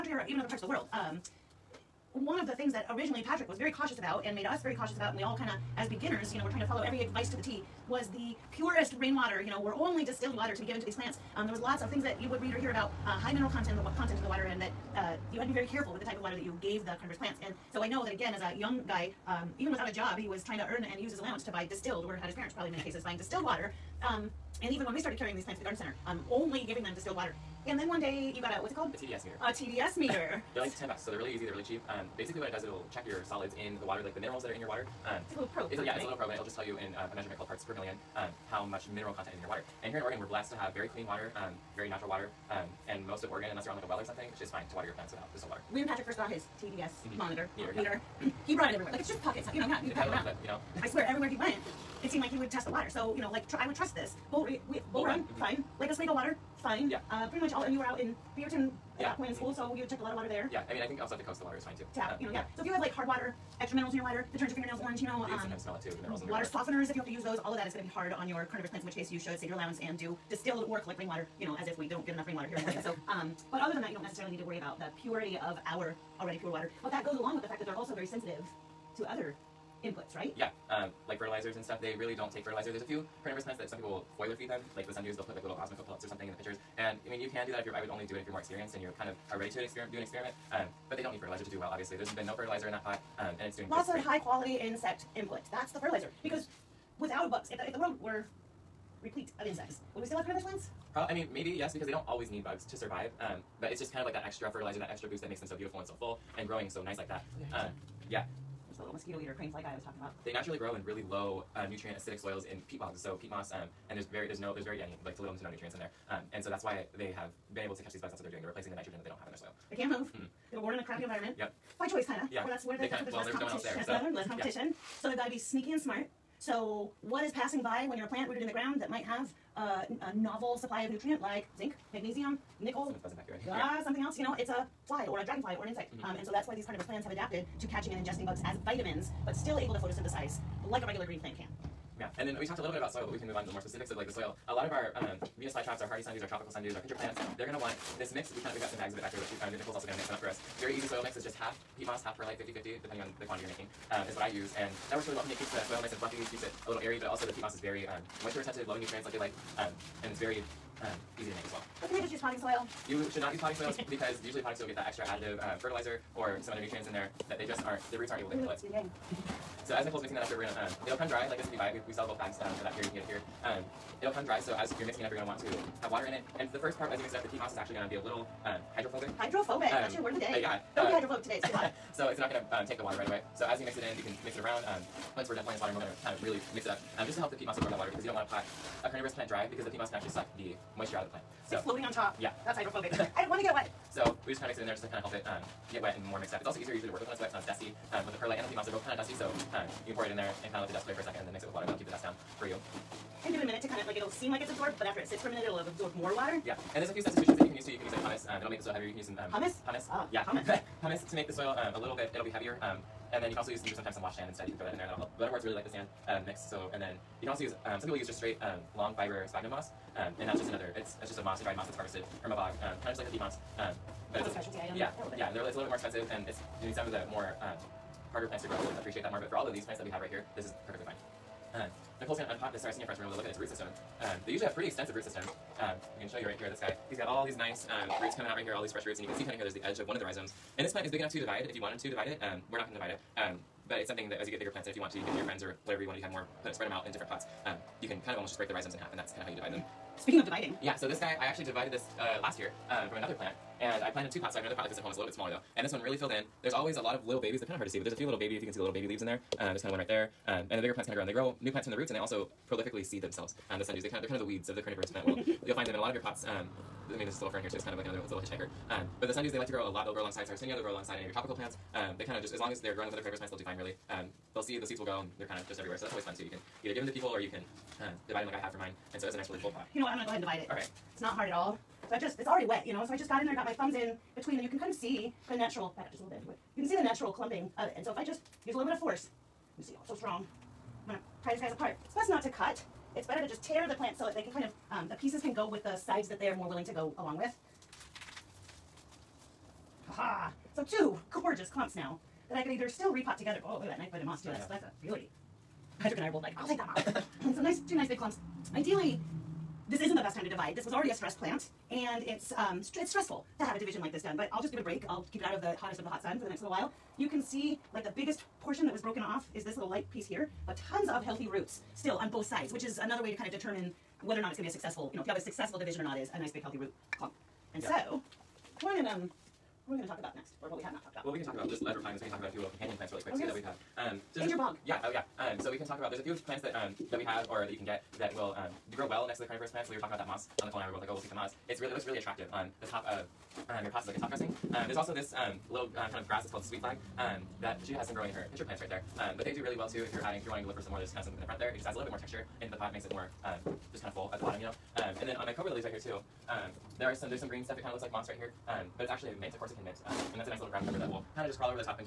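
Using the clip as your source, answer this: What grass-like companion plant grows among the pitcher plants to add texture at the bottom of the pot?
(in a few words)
sweet flag.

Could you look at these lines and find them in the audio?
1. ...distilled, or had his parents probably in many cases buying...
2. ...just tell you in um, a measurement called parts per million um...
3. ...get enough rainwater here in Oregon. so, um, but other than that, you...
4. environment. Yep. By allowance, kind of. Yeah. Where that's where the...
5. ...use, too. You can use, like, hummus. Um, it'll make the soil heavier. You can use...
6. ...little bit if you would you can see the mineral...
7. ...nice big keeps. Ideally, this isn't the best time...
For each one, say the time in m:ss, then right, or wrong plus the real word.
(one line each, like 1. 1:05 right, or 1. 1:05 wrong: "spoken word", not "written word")
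1. 0:21 right
2. 0:36 right
3. 1:12 right
4. 2:01 wrong: "choice", not "allowance"
5. 3:27 right
6. 4:46 wrong: "natural", not "mineral"
7. 5:07 wrong: "clumps", not "keeps".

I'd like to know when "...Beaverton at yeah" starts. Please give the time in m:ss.
0:58.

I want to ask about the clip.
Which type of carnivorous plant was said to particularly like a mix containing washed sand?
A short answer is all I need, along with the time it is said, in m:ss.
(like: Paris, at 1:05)
Butterworts, at 3:35.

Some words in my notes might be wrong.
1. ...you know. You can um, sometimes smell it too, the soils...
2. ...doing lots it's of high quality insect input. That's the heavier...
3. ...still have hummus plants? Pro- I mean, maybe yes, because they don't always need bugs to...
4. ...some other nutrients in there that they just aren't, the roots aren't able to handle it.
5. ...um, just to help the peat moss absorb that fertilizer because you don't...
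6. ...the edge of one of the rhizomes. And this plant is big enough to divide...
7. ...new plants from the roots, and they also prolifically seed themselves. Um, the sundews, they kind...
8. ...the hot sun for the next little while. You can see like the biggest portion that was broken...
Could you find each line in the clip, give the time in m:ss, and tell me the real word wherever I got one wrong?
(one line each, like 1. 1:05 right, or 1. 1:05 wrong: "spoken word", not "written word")
1. 1:04 wrong: "minerals", not "soils"
2. 1:33 wrong: "fertilizer", not "heavier"
3. 1:40 wrong: "carnivorous", not "hummus"
4. 2:46 right
5. 3:06 wrong: "water", not "fertilizer"
6. 3:59 right
7. 4:21 right
8. 5:15 right.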